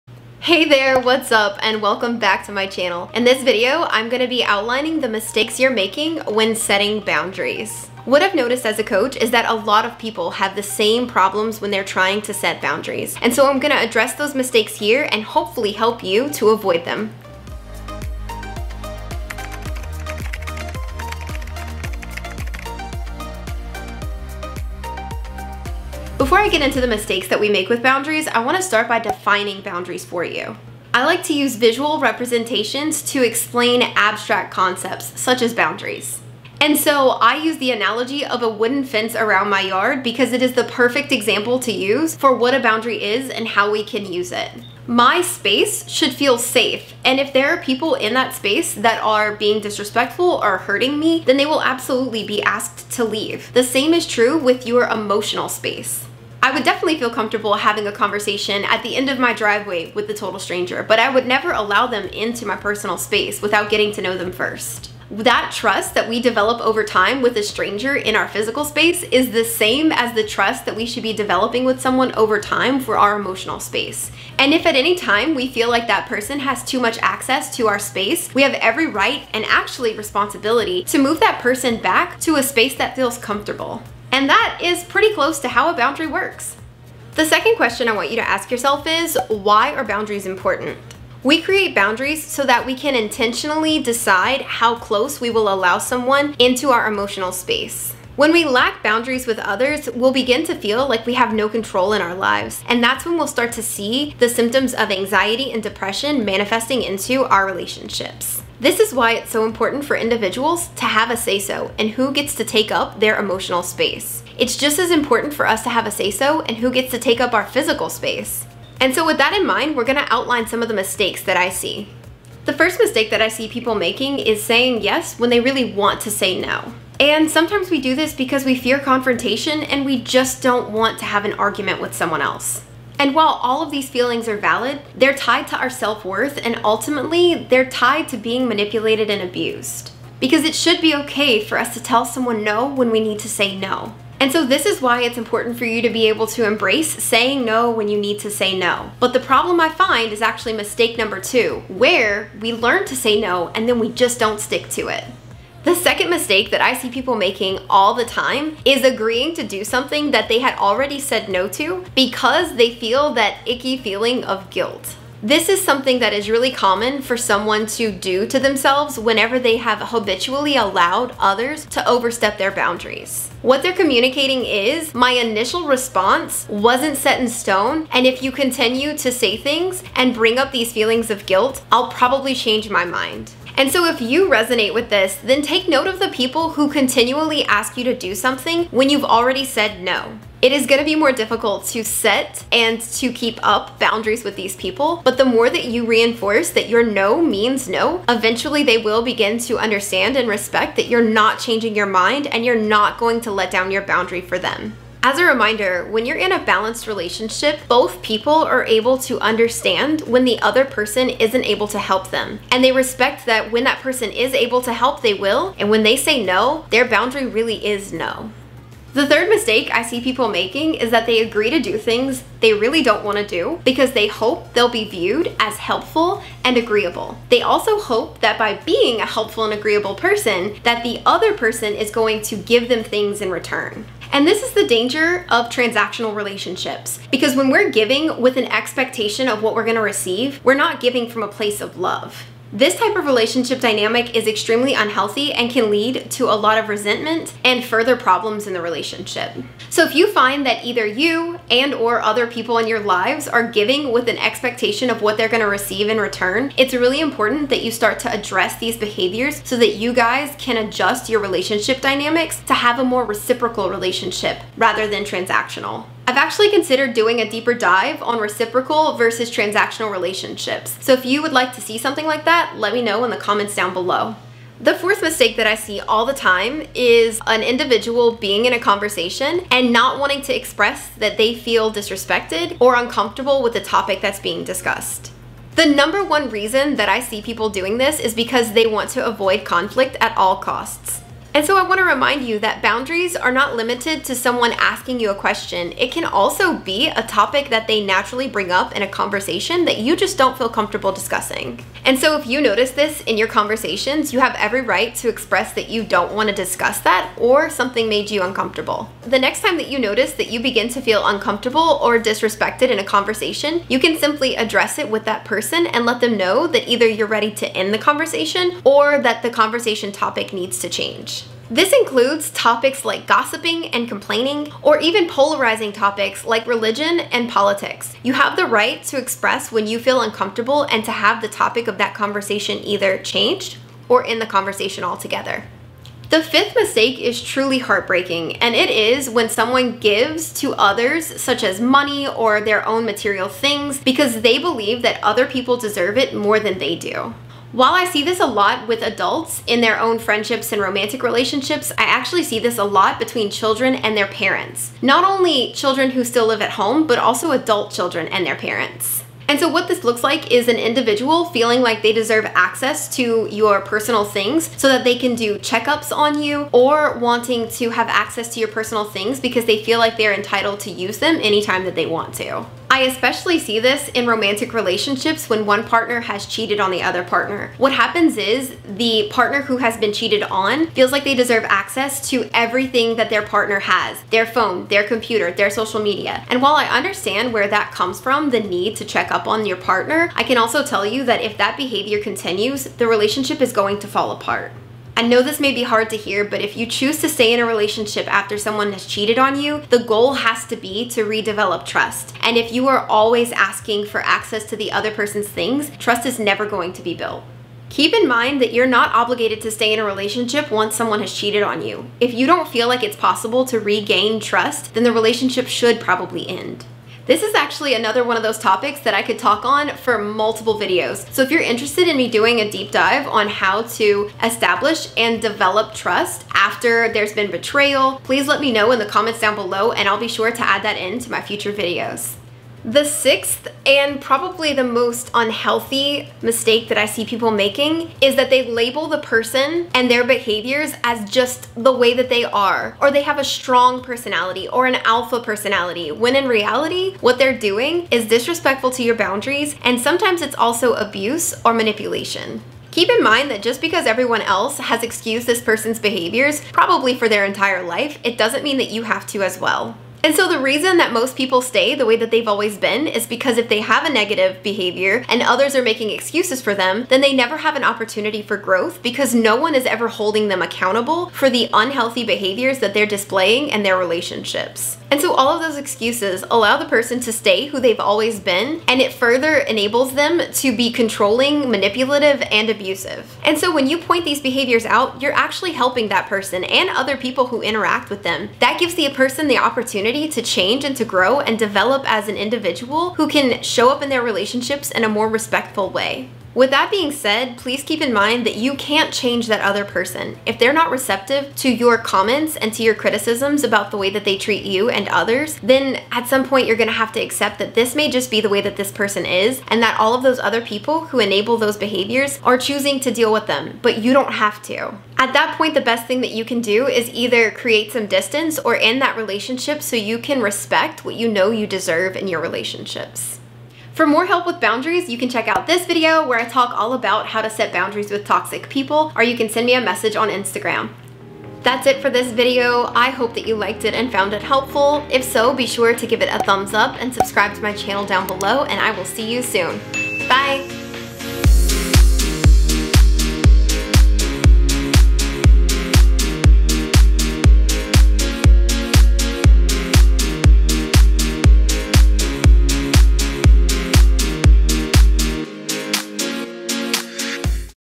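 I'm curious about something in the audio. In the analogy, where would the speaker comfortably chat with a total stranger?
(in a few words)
End of my driveway.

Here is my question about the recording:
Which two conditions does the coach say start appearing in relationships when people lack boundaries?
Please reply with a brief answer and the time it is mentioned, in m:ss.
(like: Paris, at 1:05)
Anxiety and depression, at 1:44.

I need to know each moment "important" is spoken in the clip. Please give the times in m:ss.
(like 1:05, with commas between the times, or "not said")
1:30, 1:49, 1:54, 2:25, 4:16.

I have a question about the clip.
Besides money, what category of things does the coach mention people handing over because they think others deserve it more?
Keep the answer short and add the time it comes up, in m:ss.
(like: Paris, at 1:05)
Material things, at 5:42.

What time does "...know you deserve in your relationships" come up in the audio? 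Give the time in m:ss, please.
8:41.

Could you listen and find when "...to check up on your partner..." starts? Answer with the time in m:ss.
6:28.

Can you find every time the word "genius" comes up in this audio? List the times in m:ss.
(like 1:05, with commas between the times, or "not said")
not said.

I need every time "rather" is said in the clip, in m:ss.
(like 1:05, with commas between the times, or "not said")
4:24.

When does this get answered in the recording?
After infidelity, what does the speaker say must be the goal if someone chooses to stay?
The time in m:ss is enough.
6:41.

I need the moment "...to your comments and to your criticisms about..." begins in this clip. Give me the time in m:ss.
8:21.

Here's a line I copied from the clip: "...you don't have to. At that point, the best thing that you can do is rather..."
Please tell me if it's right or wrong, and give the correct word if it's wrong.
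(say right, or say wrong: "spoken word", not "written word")
wrong: "either", not "rather".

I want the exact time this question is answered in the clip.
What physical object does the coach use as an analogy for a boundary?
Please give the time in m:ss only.
0:38.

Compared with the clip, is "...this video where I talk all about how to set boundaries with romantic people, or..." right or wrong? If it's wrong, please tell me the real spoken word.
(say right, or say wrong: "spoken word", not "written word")
wrong: "toxic", not "romantic".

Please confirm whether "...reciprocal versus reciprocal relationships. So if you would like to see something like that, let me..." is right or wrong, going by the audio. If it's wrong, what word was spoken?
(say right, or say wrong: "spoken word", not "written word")
wrong: "transactional", not "reciprocal".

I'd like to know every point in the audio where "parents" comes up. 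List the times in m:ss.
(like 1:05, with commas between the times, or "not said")
5:54, 5:58.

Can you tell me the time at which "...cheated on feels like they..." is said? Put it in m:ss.
6:19.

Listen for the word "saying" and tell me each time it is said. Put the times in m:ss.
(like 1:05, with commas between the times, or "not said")
2:04, 2:27.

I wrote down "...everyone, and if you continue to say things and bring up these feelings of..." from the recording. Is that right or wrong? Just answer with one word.
wrong.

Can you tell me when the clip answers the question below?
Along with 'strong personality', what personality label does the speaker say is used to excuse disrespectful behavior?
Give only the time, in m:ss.
7:24.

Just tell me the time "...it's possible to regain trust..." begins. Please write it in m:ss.
6:52.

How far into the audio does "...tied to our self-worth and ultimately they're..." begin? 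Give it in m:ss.
2:15.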